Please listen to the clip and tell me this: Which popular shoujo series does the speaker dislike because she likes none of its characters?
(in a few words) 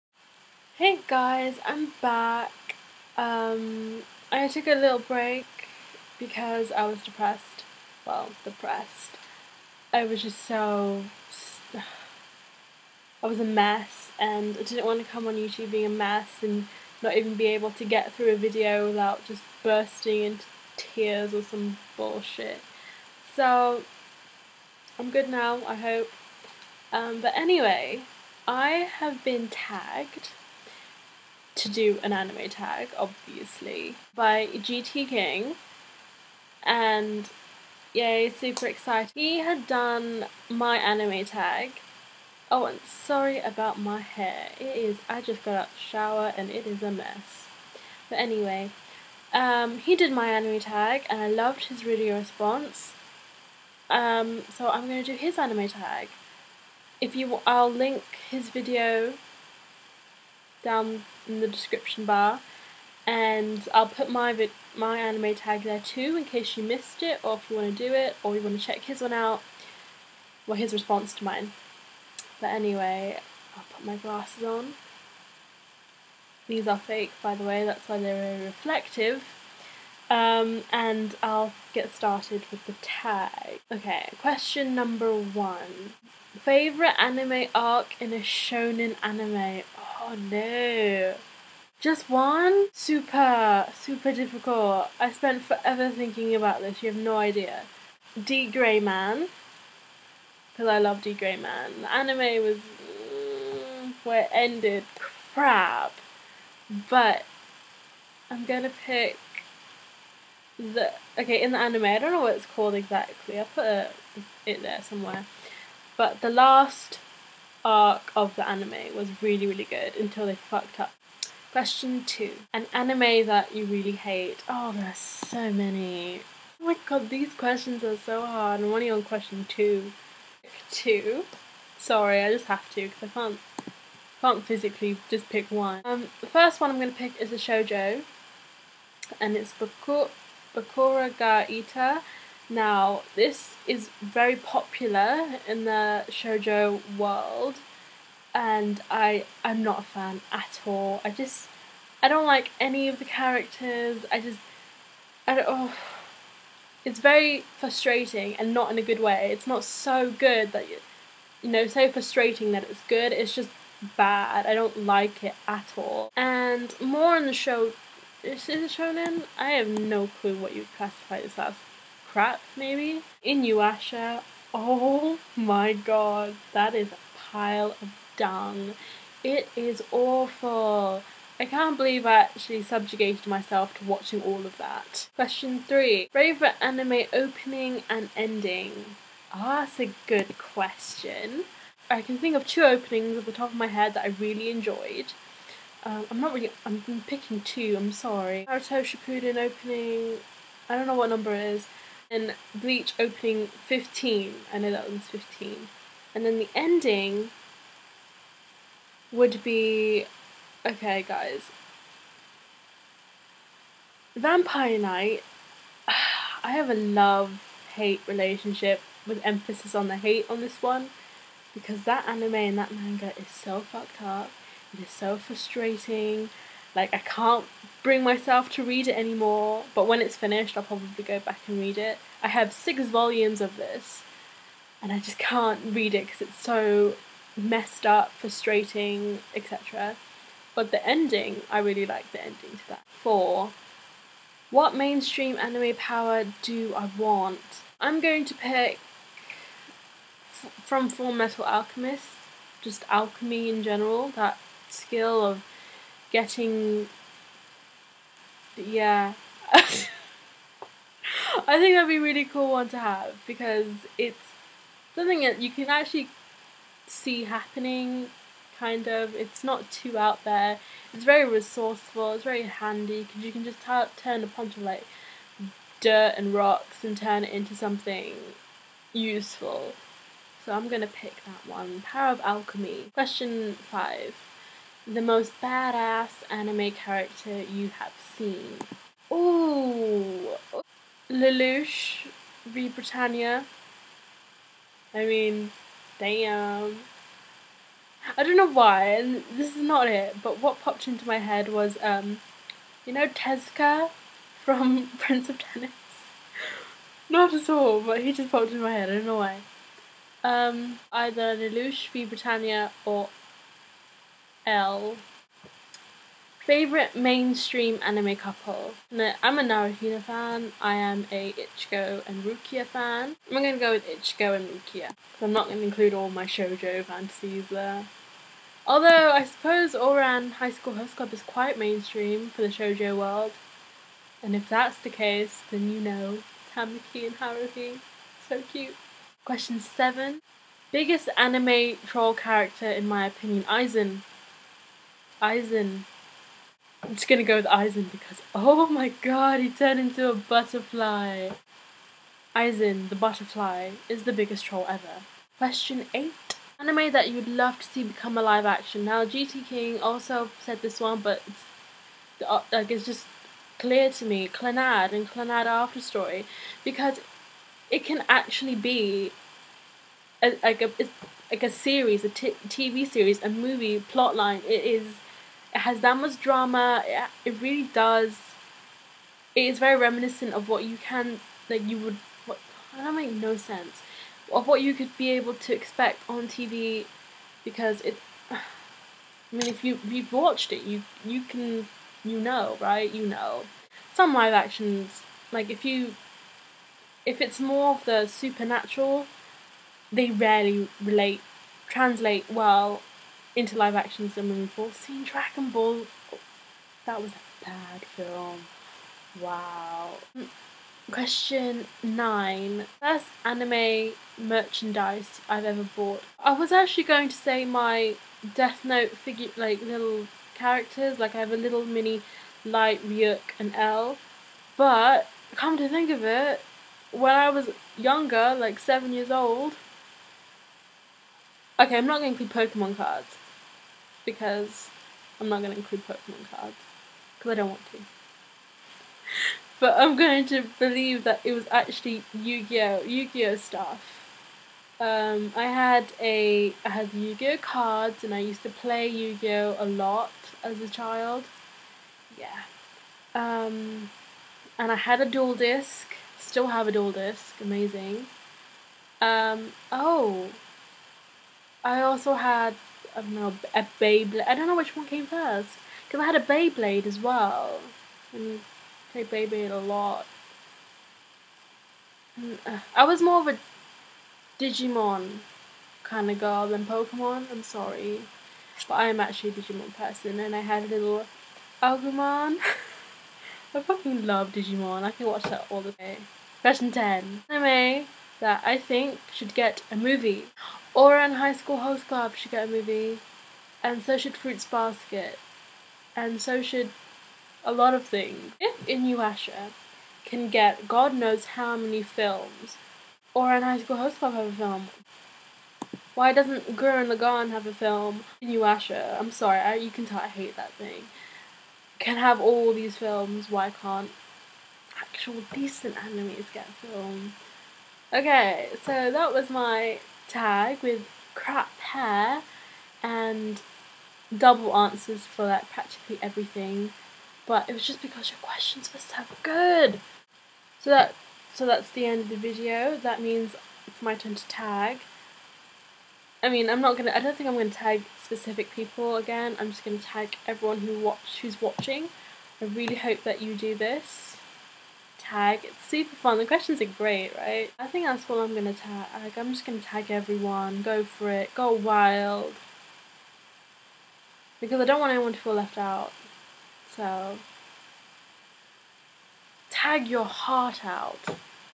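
Bokura ga Ita.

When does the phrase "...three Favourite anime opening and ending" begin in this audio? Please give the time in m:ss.
3:05.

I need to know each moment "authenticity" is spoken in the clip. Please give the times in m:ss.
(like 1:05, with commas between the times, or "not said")
not said.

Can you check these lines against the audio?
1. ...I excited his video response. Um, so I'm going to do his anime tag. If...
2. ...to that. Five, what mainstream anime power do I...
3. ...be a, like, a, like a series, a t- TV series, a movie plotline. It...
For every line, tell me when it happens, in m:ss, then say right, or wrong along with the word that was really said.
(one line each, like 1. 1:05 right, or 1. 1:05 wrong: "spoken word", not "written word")
1. 0:51 wrong: "loved", not "excited"
2. 4:02 wrong: "Four", not "Five"
3. 6:08 right.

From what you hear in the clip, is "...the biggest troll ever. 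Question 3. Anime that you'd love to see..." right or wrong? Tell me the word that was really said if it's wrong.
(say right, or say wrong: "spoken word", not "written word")
wrong: "8", not "3".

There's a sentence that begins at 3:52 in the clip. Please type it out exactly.
I have six volumes of this, and I just can't read it because it's so messed up, frustrating, etc.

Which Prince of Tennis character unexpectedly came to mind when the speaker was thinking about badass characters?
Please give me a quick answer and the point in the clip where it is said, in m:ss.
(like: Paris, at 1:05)
Tezuka, at 5:03.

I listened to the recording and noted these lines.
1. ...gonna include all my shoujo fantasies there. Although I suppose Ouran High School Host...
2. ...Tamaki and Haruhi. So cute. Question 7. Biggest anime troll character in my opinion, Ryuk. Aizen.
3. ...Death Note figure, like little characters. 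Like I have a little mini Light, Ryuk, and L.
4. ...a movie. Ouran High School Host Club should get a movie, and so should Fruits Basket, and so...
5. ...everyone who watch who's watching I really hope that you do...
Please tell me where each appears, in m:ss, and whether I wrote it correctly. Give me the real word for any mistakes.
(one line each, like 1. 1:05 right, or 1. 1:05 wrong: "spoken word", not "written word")
1. 5:25 right
2. 5:36 wrong: "Aizen", not "Ryuk"
3. 6:58 right
4. 8:09 right
5. 9:00 right.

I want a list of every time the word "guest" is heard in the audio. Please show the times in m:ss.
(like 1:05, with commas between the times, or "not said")
not said.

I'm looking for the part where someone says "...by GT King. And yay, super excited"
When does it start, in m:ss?
0:34.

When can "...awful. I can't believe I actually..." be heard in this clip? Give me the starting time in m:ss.
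2:59.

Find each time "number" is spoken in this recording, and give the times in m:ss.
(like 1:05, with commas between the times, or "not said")
1:24, 3:21.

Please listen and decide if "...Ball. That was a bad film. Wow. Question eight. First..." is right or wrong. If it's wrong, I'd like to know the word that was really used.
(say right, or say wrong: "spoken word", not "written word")
wrong: "nine", not "eight".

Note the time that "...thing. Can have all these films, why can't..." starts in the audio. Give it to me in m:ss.
8:30.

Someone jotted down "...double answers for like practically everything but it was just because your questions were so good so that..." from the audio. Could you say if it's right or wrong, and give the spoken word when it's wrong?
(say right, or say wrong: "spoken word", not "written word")
right.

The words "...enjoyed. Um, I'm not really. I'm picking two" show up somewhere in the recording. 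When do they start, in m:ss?
3:14.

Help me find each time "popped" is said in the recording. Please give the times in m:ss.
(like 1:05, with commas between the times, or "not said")
5:00, 5:08.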